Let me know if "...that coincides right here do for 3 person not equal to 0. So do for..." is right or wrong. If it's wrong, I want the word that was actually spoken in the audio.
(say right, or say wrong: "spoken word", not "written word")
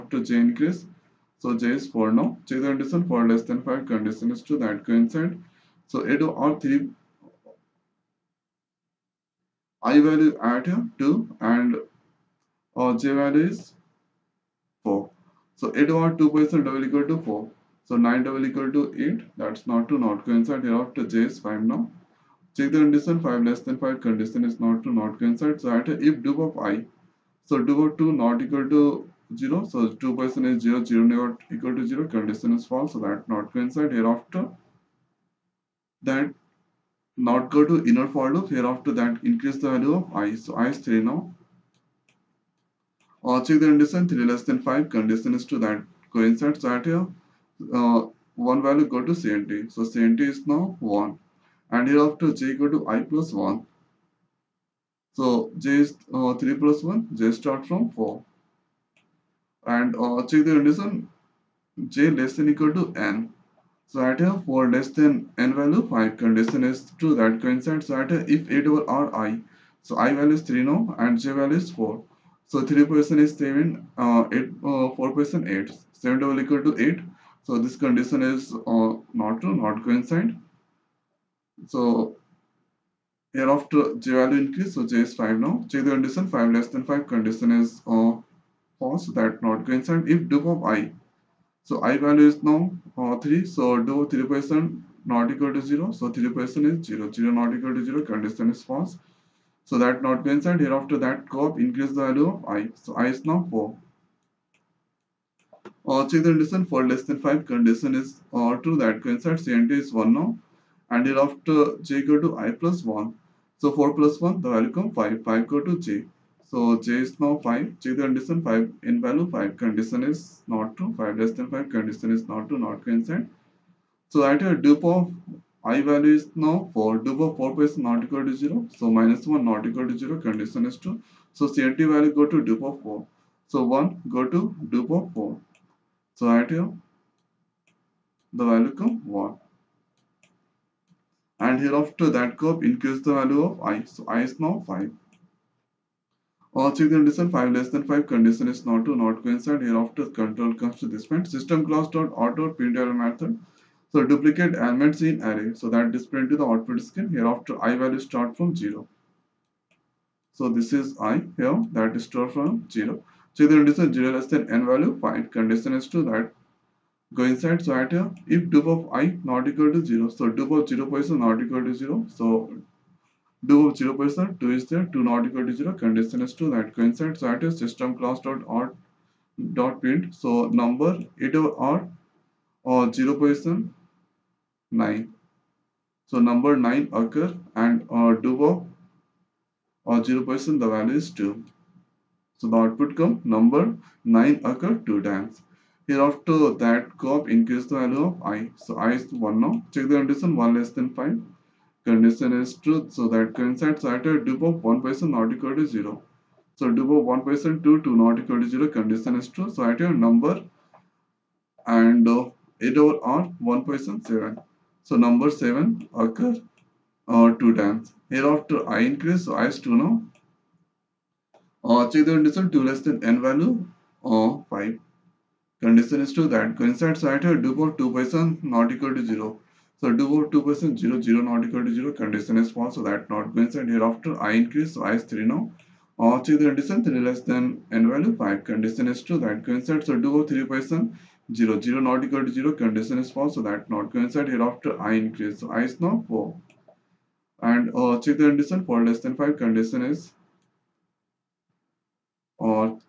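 wrong: "2", not "3".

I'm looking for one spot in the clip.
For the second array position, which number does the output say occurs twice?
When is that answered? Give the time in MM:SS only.
03:34.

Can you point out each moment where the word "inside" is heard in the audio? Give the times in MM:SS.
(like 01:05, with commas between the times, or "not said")
02:47, 02:56.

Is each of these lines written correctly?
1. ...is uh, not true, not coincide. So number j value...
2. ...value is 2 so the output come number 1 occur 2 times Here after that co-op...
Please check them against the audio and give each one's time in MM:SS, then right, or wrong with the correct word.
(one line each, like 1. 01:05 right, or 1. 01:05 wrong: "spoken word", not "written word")
1. 01:18 wrong: "hereafter", not "number"
2. 03:10 wrong: "9", not "1".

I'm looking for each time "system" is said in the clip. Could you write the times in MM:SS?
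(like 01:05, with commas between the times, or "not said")
02:31, 02:57.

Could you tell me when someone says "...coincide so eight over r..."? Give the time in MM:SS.
00:04.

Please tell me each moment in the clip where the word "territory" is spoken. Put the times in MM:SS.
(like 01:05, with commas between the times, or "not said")
not said.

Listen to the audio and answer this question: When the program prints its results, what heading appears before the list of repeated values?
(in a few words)
duplicate elements in array.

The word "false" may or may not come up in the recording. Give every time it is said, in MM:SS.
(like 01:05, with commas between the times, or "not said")
00:32, 01:28, 01:38, 03:52, 04:03.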